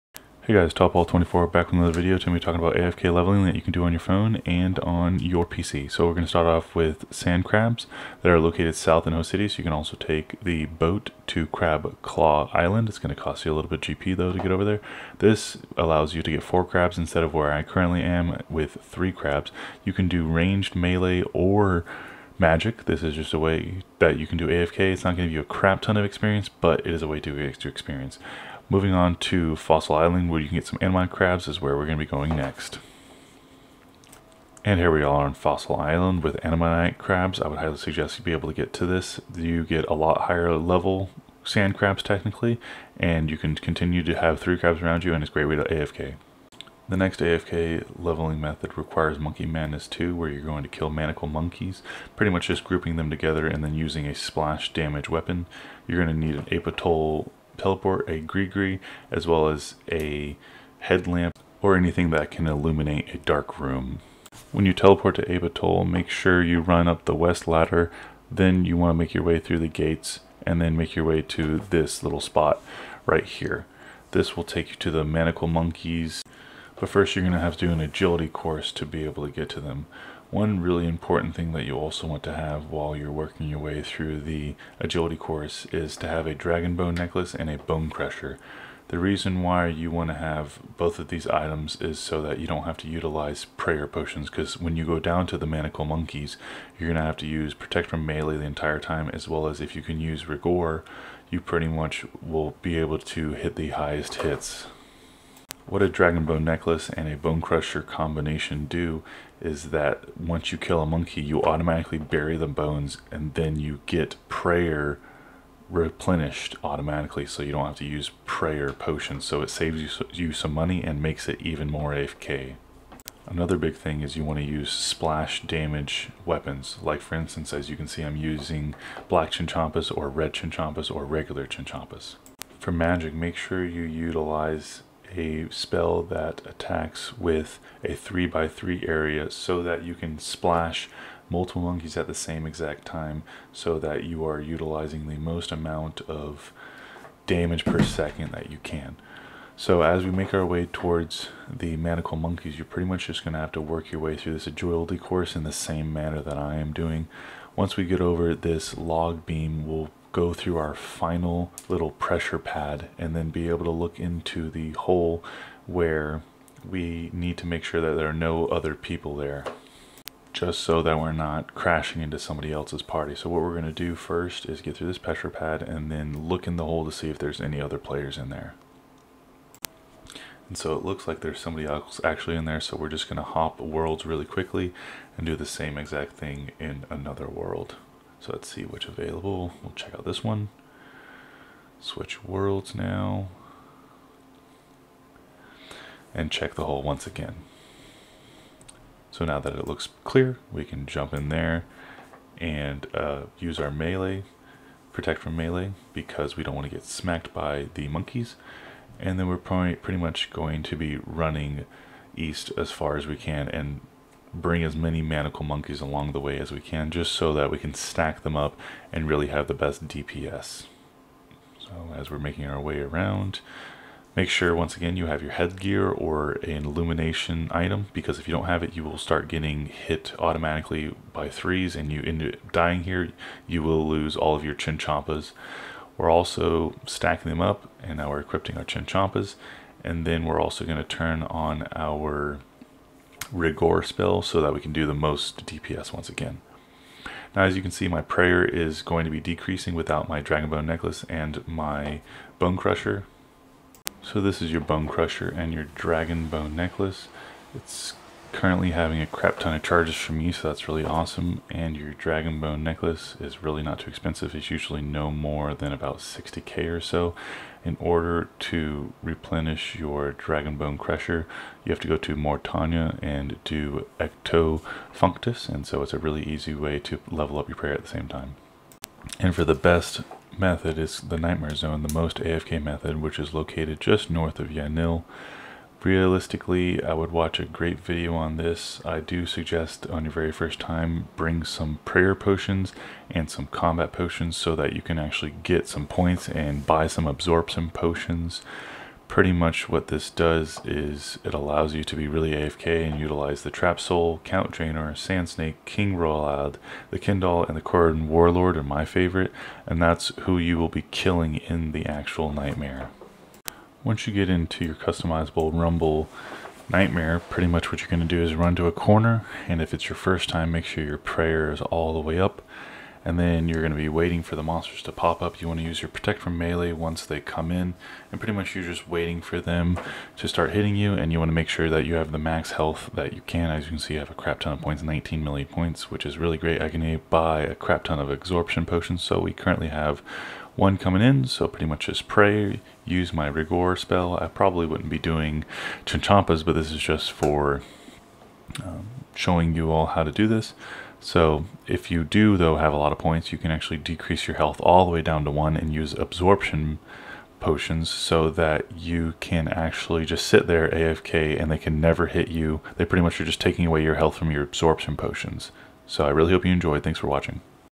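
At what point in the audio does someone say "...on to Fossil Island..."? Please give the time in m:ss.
0:28.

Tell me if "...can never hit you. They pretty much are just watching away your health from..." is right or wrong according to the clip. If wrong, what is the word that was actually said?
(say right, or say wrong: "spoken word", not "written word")
wrong: "taking", not "watching".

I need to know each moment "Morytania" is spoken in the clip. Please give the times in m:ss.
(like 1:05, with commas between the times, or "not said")
4:32.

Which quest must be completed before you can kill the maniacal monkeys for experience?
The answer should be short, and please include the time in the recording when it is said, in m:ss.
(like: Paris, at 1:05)
Monkey Madness 2, at 0:49.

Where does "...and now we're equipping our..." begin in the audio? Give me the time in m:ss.
3:57.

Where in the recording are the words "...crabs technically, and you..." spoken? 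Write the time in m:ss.
0:41.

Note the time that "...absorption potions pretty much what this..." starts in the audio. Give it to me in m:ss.
4:57.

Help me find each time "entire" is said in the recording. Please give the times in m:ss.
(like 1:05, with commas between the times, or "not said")
1:38.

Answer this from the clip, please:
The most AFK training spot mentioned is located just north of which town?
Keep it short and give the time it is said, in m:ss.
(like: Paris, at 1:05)
Yanille, at 4:44.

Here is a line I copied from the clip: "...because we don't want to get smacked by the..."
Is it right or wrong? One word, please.
right.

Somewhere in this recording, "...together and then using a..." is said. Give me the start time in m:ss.
0:53.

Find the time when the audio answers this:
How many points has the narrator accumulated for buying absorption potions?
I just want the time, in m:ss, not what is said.
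5:34.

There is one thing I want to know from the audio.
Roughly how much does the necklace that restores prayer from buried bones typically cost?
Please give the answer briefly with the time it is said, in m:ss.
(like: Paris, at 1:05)
60k, at 4:25.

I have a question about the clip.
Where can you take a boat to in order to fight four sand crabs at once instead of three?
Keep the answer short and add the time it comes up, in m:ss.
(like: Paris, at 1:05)
Crab Claw Island, at 0:11.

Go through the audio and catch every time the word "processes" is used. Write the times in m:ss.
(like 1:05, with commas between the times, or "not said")
not said.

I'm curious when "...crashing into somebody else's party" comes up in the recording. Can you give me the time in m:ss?
2:51.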